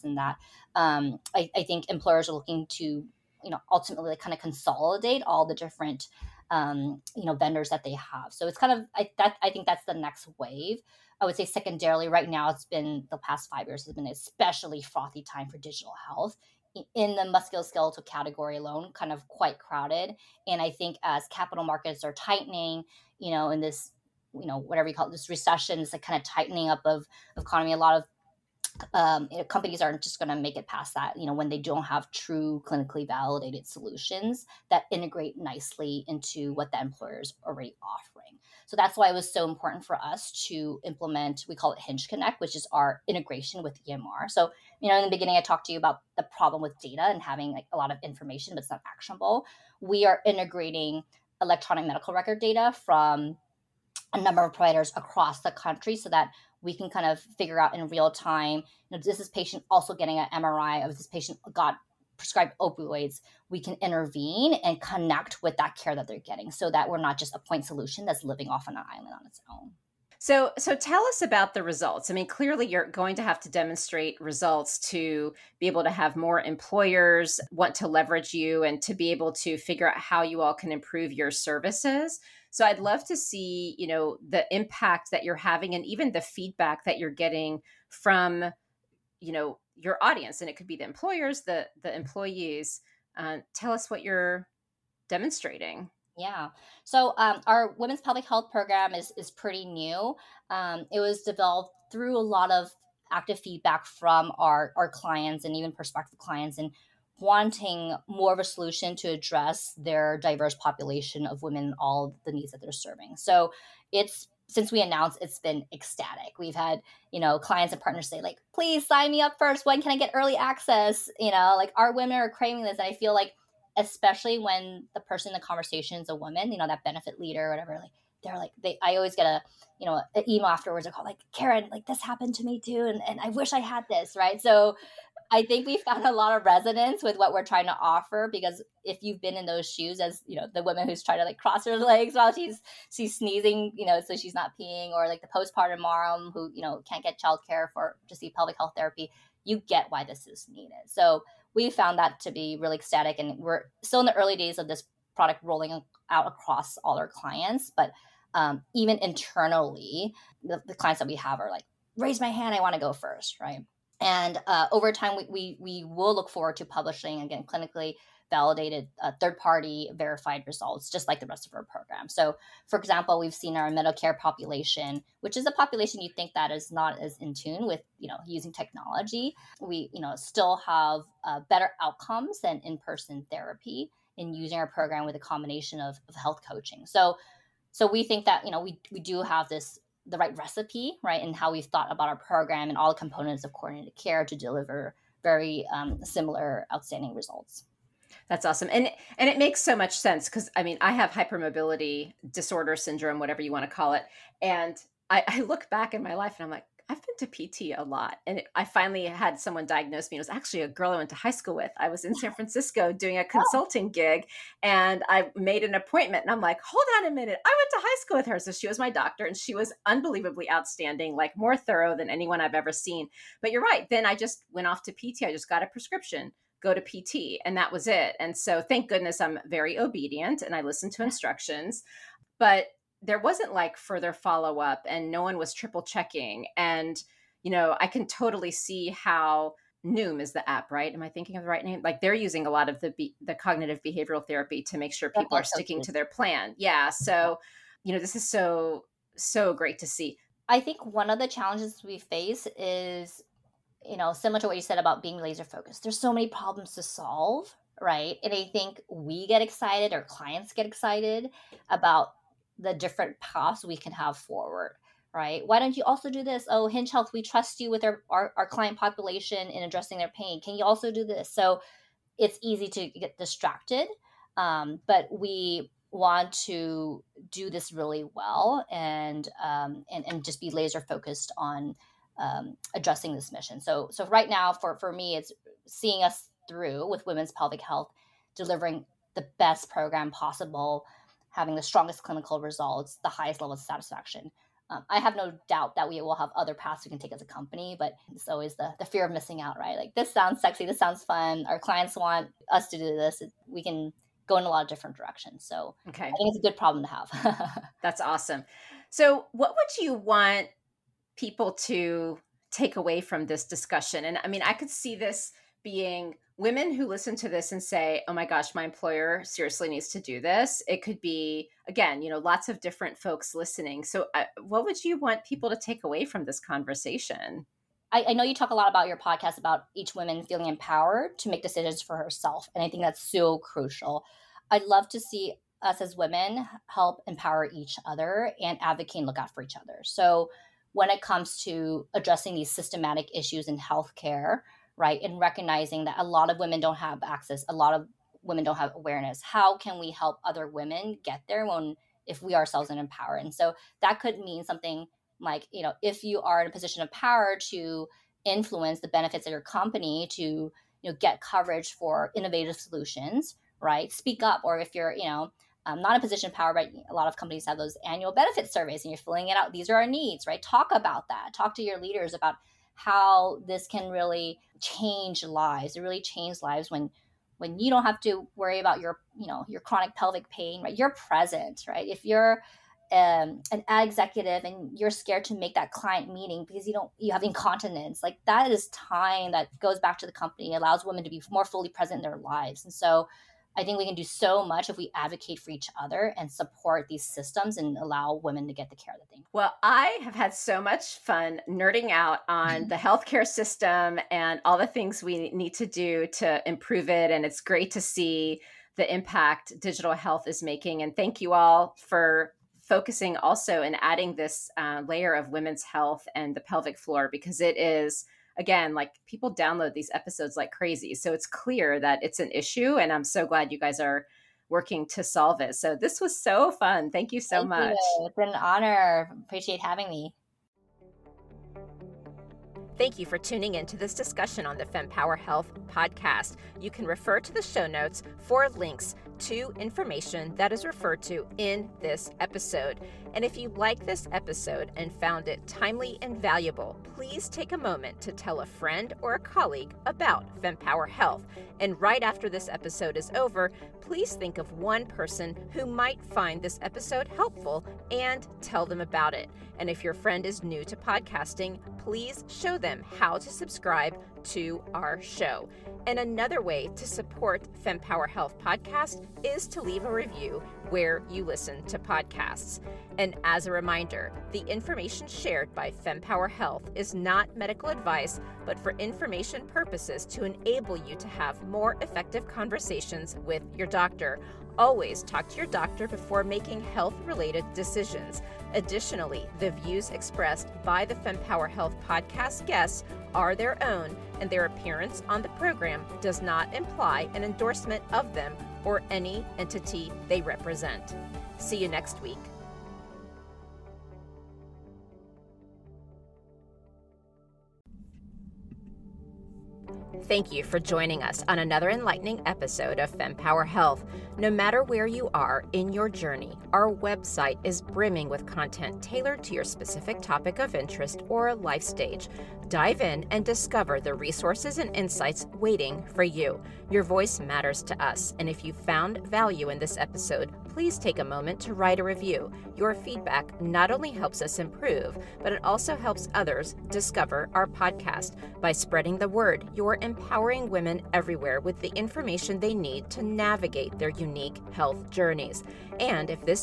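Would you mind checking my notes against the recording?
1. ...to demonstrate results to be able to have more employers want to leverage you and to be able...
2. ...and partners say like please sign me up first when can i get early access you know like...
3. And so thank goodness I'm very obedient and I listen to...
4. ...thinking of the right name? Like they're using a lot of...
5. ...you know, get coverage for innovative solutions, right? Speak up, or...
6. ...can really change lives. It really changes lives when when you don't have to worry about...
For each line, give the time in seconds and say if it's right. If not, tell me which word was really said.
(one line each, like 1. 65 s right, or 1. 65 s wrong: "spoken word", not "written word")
1. 73 s right
2. 117 s right
3. 228 s right
4. 241 s right
5. 360 s right
6. 373 s right.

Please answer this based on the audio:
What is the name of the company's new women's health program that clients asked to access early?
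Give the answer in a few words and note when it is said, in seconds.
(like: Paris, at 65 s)
women's pelvic health program, at 97 s.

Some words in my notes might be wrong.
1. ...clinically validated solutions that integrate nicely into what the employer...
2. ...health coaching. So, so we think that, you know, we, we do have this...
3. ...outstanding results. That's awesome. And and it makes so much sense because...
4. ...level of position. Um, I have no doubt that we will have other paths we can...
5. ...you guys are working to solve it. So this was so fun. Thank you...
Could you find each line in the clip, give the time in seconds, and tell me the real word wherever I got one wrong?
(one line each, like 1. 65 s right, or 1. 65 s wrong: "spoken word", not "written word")
1. 32 s right
2. 186 s right
3. 196 s right
4. 293 s wrong: "satisfaction", not "position"
5. 423 s right.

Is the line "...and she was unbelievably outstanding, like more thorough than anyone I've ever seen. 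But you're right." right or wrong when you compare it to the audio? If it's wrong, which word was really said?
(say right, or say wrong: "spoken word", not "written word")
right.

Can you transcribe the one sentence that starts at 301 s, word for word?
Our clients want us to do this.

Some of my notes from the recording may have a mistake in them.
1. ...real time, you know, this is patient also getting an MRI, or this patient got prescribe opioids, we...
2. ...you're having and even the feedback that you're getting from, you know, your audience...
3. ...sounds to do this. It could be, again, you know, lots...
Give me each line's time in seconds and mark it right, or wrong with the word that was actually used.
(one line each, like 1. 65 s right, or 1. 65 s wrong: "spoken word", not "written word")
1. 57 s right
2. 85 s right
3. 319 s wrong: "needs", not "sounds".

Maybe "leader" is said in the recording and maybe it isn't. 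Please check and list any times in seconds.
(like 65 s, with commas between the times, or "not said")
127 s, 371 s.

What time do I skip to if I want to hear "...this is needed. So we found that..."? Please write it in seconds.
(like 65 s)
150 s.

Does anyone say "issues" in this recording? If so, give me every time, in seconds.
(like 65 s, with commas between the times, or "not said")
343 s, 422 s.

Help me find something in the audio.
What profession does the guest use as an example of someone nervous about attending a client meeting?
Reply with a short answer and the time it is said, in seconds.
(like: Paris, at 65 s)
ad executive, at 383 s.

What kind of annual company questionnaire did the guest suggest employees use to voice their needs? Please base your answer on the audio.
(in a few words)
benefit surveys.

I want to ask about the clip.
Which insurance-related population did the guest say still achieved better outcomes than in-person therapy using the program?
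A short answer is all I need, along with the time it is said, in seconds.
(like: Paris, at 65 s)
Medicare, at 173 s.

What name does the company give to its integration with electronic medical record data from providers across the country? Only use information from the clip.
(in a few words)
Hinge Connect.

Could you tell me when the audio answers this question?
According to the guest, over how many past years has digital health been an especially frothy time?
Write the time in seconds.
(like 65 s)
13 s.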